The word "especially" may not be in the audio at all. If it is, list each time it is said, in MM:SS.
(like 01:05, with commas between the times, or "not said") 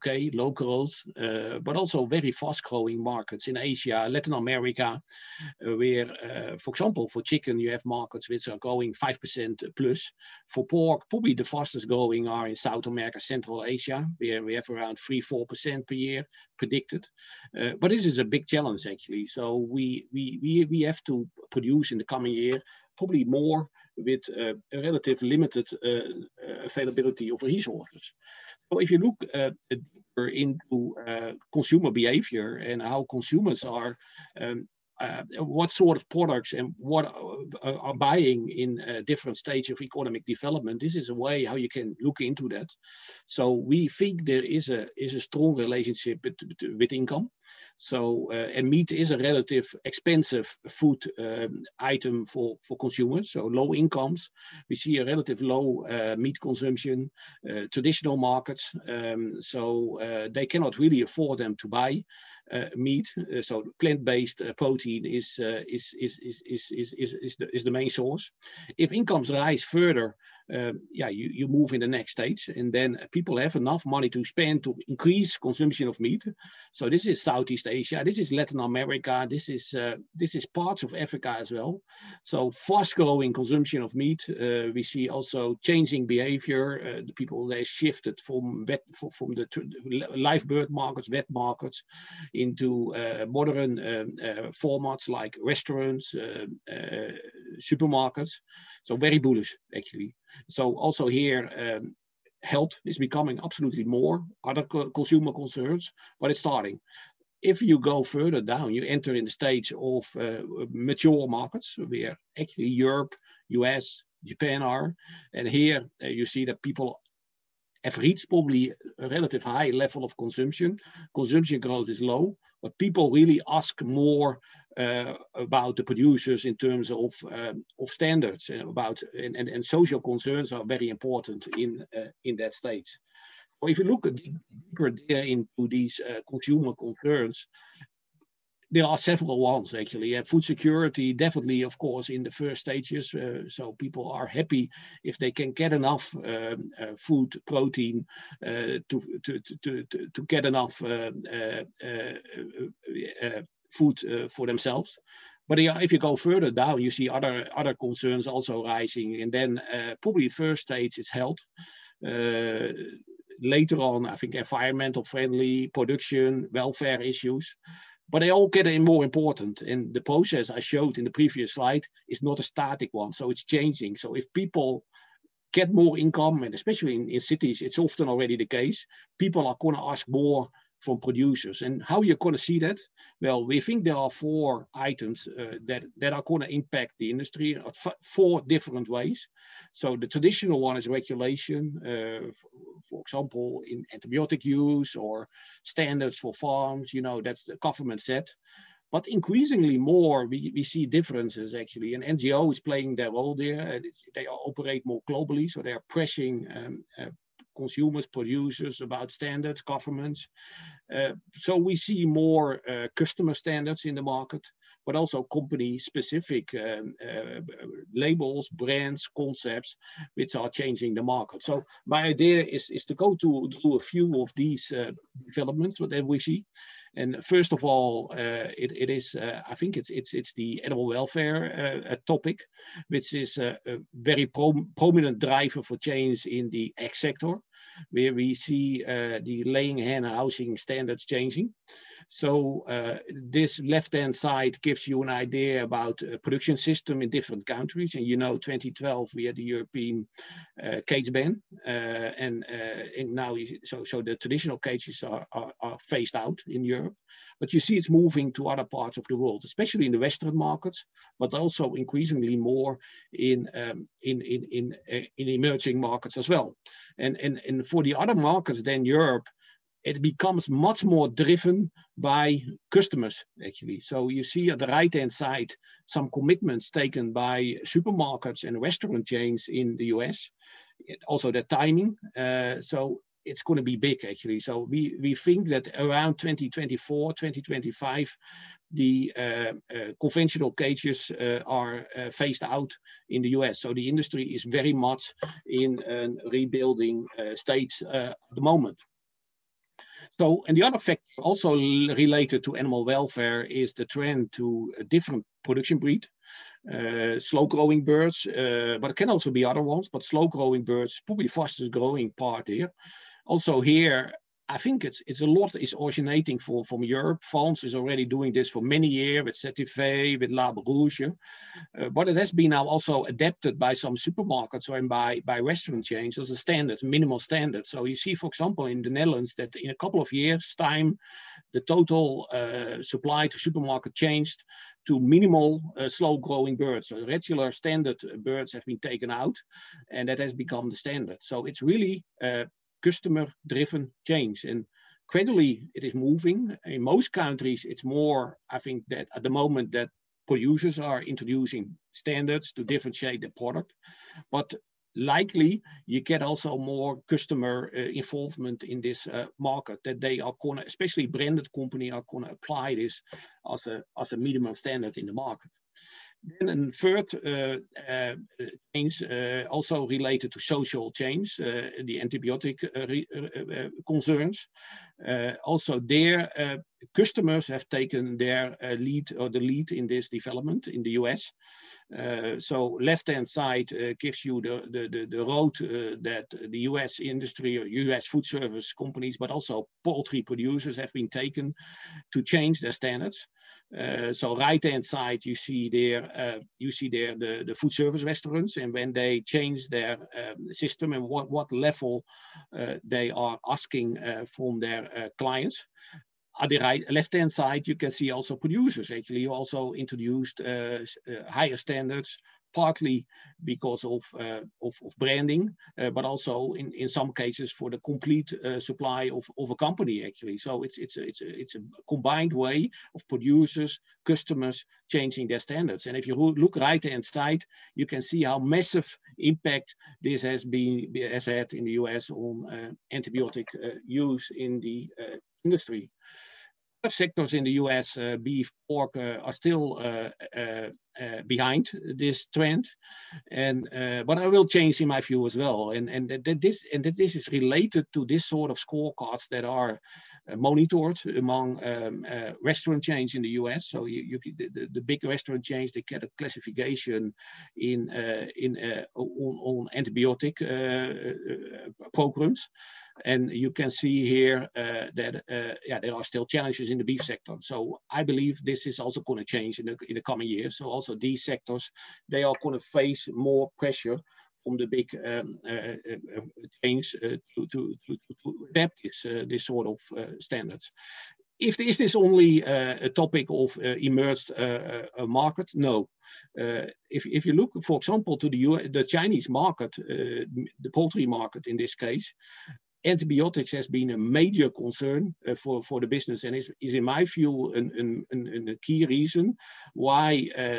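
02:56, 04:19, 06:00.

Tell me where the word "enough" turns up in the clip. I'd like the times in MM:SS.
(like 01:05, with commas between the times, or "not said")
01:13, 02:25, 02:30.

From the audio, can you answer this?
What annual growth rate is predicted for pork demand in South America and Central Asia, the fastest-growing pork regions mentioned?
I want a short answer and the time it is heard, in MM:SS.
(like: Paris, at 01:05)
3-4%, at 00:14.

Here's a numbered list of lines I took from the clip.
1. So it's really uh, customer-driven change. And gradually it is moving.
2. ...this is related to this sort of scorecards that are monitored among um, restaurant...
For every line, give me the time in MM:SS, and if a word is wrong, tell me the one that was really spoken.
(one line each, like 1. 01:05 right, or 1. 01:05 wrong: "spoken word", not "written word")
1. 05:41 right
2. 07:26 right.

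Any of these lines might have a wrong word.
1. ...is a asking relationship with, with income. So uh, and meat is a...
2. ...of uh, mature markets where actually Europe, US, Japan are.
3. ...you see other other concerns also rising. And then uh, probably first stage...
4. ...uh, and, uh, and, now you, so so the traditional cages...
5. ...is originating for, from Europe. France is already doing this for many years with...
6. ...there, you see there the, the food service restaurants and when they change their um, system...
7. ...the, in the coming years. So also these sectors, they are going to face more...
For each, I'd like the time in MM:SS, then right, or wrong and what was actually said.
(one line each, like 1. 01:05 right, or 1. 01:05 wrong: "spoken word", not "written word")
1. 00:44 wrong: "strong", not "asking"
2. 01:49 right
3. 02:36 right
4. 04:11 right
5. 05:15 right
6. 06:35 right
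7. 07:49 right.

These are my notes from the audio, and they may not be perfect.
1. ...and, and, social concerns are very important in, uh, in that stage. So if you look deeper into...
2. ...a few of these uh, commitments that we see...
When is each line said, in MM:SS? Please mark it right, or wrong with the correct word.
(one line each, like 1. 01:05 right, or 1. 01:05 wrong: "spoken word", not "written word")
1. 02:09 right
2. 03:43 wrong: "developments", not "commitments".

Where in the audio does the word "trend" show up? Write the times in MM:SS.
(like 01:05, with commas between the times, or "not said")
05:03, 07:22.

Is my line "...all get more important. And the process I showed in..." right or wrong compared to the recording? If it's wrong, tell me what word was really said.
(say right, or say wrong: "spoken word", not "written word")
right.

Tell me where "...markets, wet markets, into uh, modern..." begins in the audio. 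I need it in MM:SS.
01:30.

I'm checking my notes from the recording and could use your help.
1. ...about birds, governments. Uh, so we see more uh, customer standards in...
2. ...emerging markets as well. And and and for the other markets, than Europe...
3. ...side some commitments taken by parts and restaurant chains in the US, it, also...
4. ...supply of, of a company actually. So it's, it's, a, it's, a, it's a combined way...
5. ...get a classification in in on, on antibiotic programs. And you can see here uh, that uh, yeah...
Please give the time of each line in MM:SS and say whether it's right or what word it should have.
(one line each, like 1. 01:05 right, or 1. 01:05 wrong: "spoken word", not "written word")
1. 03:28 wrong: "standards", not "birds"
2. 04:25 right
3. 04:35 wrong: "supermarkets", not "parts"
4. 06:58 right
5. 07:35 right.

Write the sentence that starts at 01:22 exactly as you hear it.
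So fast growing consumption of meat.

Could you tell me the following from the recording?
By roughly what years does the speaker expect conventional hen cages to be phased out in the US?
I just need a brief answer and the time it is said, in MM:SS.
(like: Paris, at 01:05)
2024, 2025, at 04:46.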